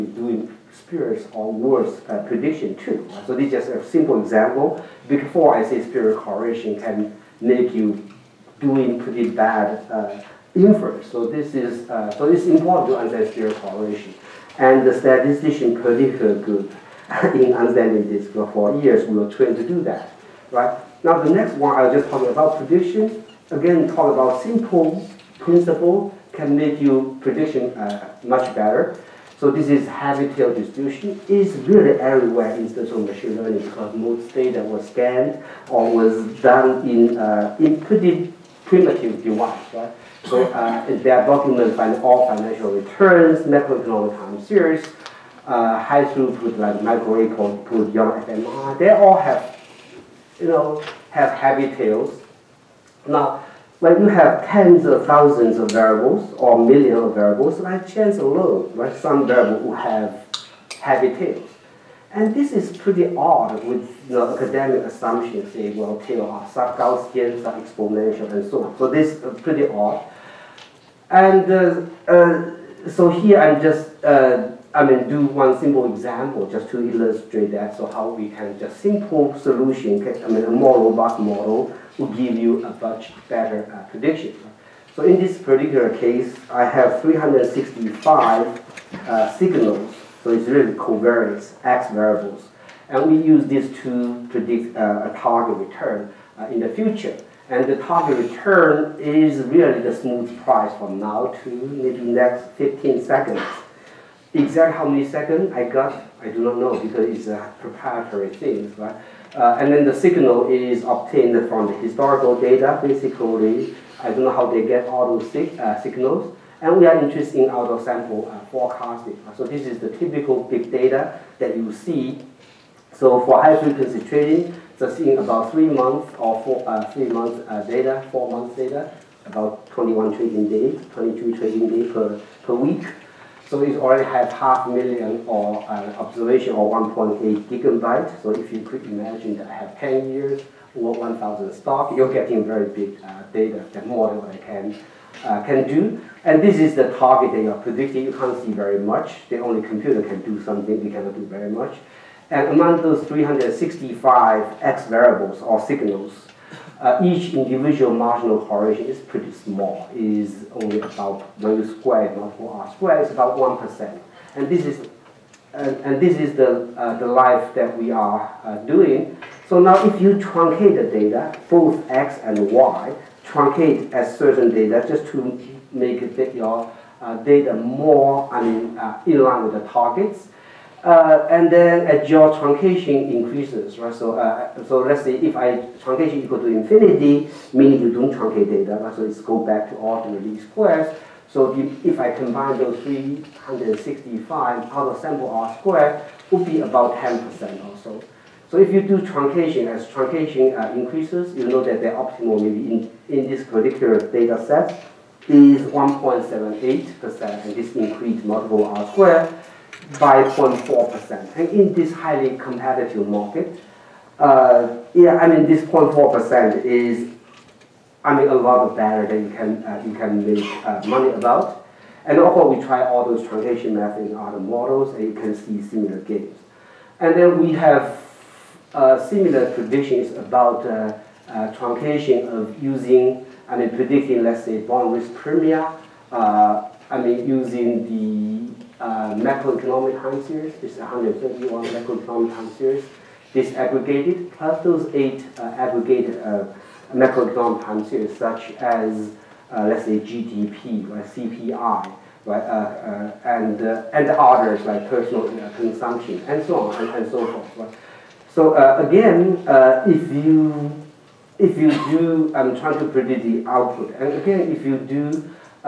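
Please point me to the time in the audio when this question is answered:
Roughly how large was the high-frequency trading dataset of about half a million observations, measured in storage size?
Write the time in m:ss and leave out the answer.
2:16.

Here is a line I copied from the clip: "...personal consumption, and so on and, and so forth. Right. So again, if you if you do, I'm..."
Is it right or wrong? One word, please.
right.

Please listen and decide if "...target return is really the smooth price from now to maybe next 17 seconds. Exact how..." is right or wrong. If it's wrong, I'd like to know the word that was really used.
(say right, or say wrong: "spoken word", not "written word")
wrong: "15", not "17".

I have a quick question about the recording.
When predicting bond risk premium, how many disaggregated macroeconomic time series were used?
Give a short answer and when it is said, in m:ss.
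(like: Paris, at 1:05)
171, at 4:00.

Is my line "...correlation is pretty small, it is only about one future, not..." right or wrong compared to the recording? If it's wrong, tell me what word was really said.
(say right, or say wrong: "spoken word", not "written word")
wrong: "square", not "future".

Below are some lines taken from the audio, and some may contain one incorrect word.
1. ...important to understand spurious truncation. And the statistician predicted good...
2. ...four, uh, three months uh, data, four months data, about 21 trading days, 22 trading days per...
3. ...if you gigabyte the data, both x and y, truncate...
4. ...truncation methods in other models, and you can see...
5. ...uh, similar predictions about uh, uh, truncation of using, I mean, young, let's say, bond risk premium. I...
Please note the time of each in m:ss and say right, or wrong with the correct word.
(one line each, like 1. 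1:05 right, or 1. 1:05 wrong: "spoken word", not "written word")
1. 0:12 wrong: "correlation", not "truncation"
2. 2:06 right
3. 2:49 wrong: "truncate", not "gigabyte"
4. 3:43 right
5. 3:48 wrong: "predicting", not "young".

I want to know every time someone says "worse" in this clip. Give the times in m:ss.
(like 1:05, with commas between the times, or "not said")
0:01.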